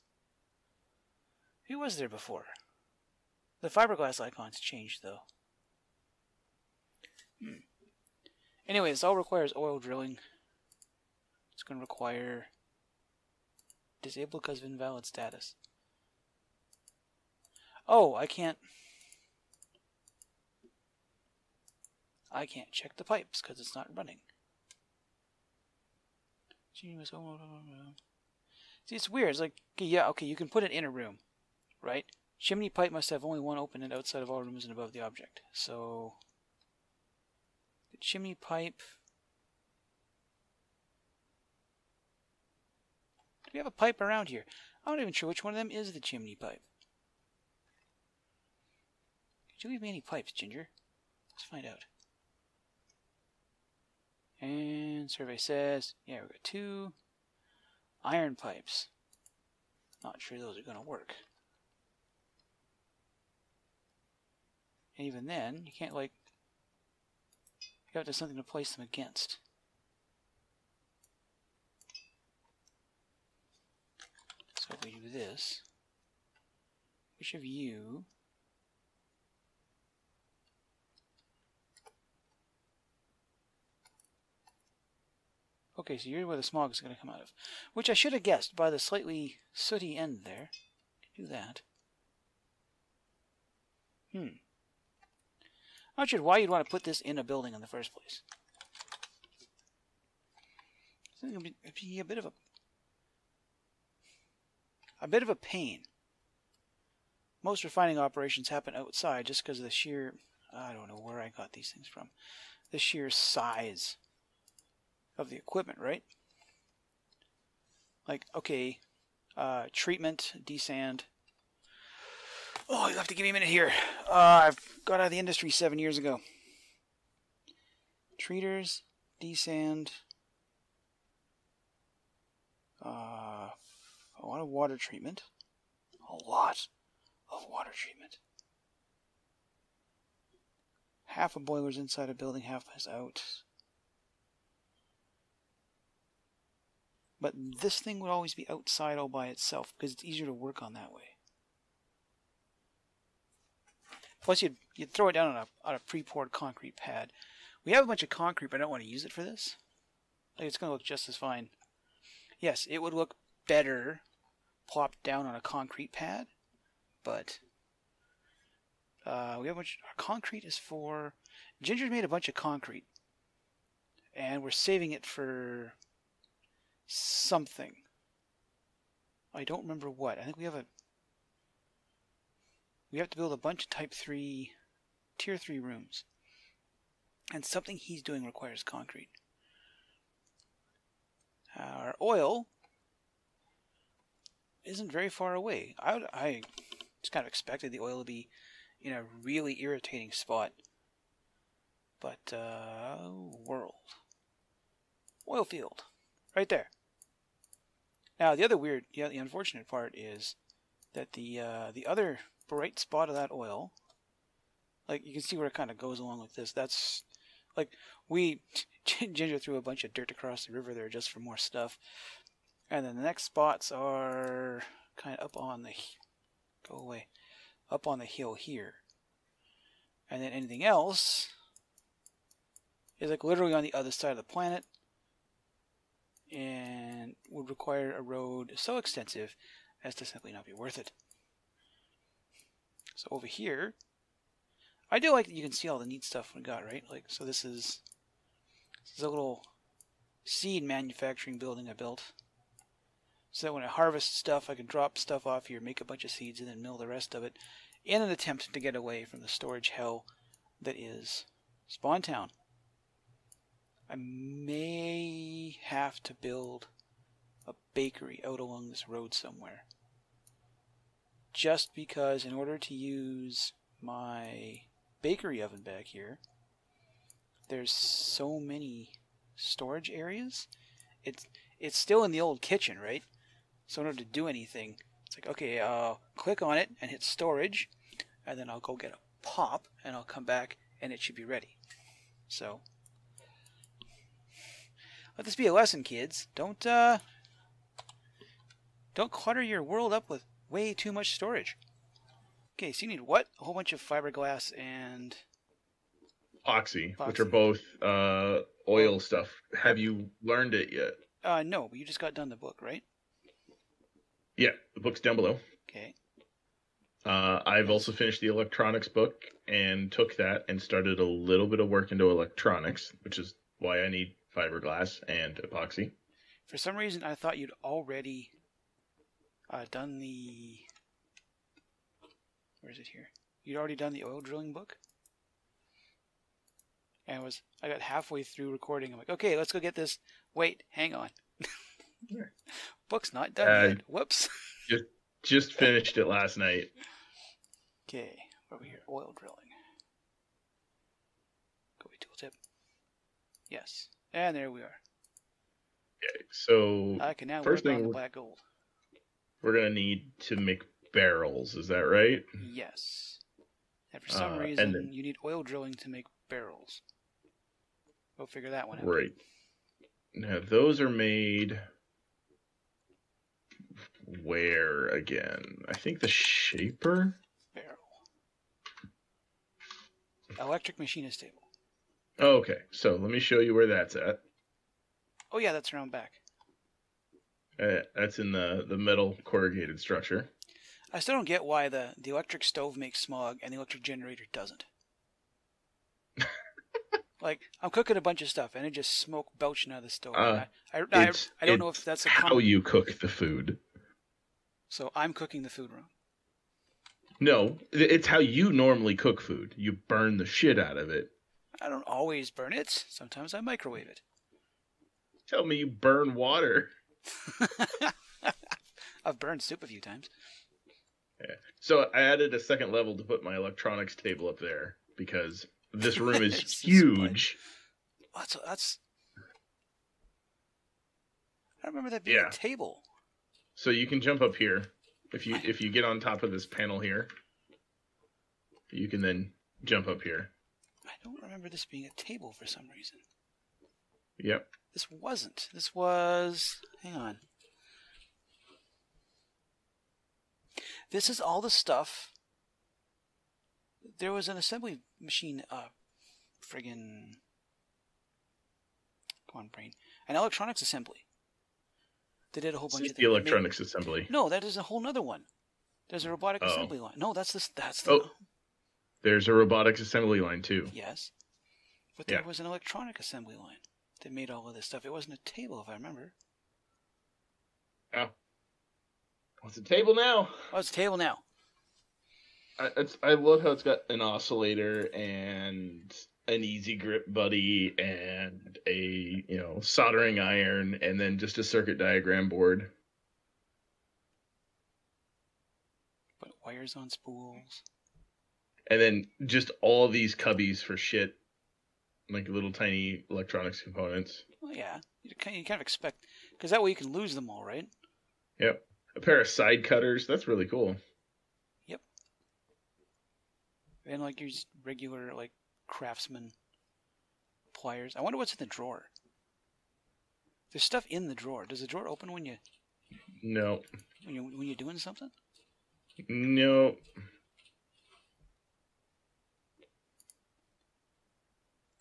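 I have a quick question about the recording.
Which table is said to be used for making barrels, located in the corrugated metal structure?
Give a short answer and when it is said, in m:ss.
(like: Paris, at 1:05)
Electric machinist table, at 6:20.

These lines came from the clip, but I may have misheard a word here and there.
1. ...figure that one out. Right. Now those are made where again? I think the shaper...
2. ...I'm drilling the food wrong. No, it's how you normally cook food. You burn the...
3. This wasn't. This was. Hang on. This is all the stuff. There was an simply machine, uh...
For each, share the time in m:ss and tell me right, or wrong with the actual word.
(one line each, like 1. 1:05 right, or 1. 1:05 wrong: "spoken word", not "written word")
1. 6:08 right
2. 6:44 wrong: "cooking", not "drilling"
3. 7:24 wrong: "assembly", not "simply".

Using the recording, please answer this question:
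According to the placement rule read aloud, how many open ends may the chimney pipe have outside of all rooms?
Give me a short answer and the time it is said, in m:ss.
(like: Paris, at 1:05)
1, at 0:33.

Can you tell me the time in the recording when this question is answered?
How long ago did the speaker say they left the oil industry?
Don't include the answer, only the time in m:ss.
2:05.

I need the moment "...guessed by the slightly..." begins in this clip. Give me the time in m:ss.
1:28.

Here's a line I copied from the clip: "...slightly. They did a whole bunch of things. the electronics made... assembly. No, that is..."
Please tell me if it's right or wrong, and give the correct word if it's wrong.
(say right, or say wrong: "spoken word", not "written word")
wrong: "assembly", not "slightly".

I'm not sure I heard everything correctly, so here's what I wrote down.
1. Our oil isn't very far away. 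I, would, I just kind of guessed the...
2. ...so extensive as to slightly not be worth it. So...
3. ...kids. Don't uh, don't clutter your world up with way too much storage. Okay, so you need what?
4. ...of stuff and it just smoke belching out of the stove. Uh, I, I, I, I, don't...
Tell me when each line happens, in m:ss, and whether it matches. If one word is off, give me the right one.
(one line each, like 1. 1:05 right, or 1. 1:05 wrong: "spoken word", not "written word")
1. 3:11 wrong: "expected", not "guessed"
2. 3:58 wrong: "simply", not "slightly"
3. 4:55 right
4. 6:38 right.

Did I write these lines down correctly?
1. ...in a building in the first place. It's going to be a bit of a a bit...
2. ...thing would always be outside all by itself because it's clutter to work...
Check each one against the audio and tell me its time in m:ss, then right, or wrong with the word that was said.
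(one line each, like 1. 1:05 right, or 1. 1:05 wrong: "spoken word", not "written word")
1. 1:37 right
2. 2:27 wrong: "easier", not "clutter".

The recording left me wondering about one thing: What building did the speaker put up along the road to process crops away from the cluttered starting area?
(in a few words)
Seed manufacturing building.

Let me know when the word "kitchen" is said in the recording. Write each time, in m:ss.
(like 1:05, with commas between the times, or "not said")
4:42.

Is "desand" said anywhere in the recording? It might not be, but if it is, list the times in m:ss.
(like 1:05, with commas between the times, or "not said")
2:00, 2:09.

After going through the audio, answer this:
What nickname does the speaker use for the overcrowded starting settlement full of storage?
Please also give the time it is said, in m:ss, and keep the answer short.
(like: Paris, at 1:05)
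Spawn Town, at 4:21.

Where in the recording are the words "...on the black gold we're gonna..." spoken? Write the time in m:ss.
5:57.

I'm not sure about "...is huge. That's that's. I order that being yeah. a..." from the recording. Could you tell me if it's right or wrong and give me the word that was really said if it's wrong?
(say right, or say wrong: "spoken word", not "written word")
wrong: "remember", not "order".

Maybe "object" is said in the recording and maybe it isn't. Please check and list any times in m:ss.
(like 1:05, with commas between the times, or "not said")
0:35.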